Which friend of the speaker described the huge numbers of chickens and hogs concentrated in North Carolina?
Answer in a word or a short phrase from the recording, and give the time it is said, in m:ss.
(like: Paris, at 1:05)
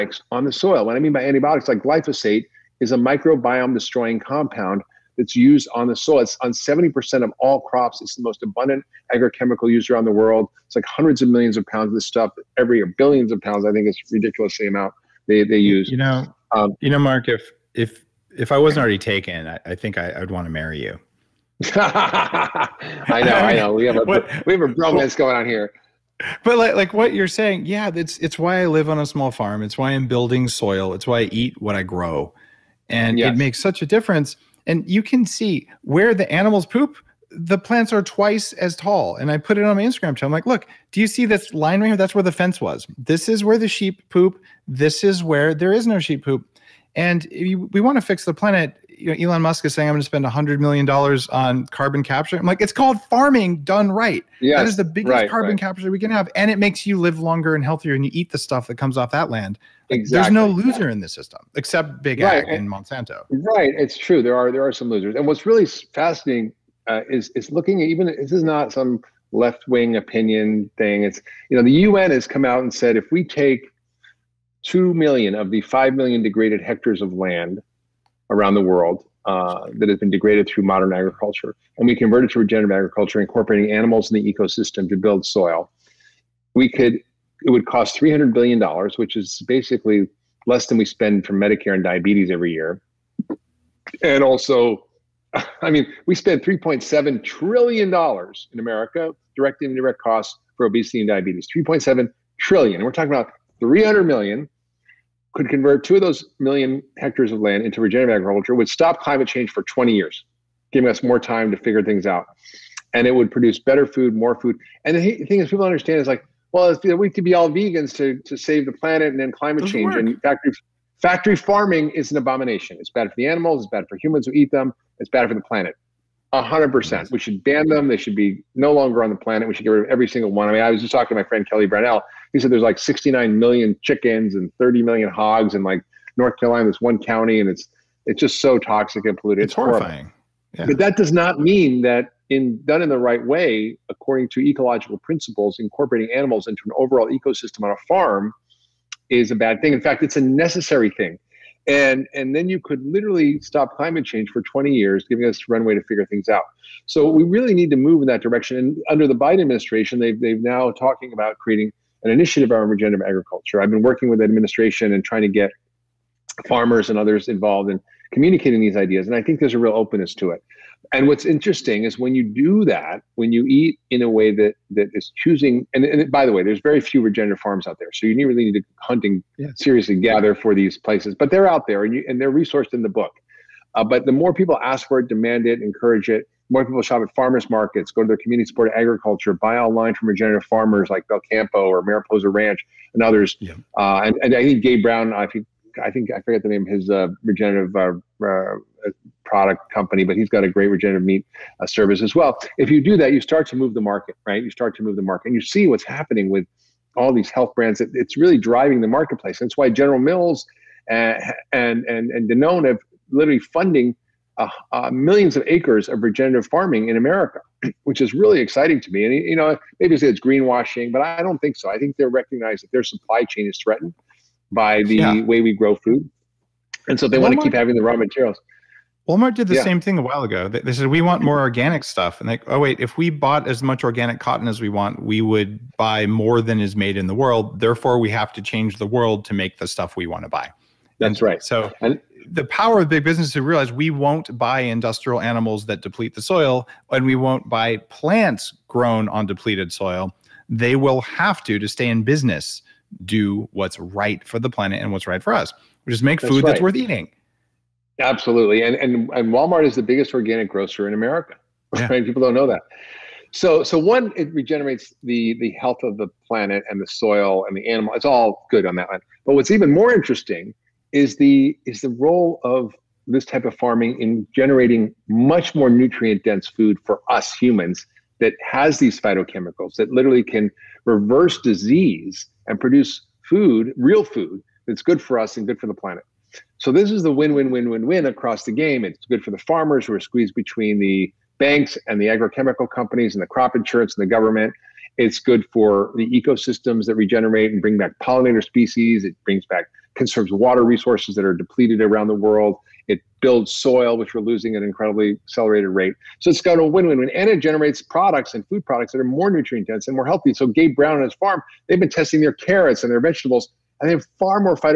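Kelly Brownell, at 2:11.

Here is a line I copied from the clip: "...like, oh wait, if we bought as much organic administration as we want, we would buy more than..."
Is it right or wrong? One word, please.
wrong.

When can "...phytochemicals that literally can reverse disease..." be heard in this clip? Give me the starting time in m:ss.
4:38.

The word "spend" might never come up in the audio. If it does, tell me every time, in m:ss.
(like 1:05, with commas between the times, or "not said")
0:50, 1:30, 1:36.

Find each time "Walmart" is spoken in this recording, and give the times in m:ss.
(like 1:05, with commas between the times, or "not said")
3:49, 4:19.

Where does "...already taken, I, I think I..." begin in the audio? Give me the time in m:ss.
0:18.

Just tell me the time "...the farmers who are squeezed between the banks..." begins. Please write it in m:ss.
4:49.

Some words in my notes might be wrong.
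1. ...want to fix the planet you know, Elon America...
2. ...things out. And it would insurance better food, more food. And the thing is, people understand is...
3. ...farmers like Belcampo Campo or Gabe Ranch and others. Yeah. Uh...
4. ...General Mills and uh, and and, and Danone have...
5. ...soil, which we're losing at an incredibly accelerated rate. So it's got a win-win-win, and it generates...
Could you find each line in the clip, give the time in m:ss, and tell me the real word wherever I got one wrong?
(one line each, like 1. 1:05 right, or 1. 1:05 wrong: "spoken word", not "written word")
1. 0:47 wrong: "Musk", not "America"
2. 1:51 wrong: "produce", not "insurance"
3. 3:10 wrong: "Mariposa", not "Gabe"
4. 3:29 right
5. 5:03 right.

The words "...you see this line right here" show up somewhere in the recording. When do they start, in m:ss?
0:41.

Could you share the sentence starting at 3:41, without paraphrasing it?
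I think they're recognized that their supply chain is threatened by the yeah.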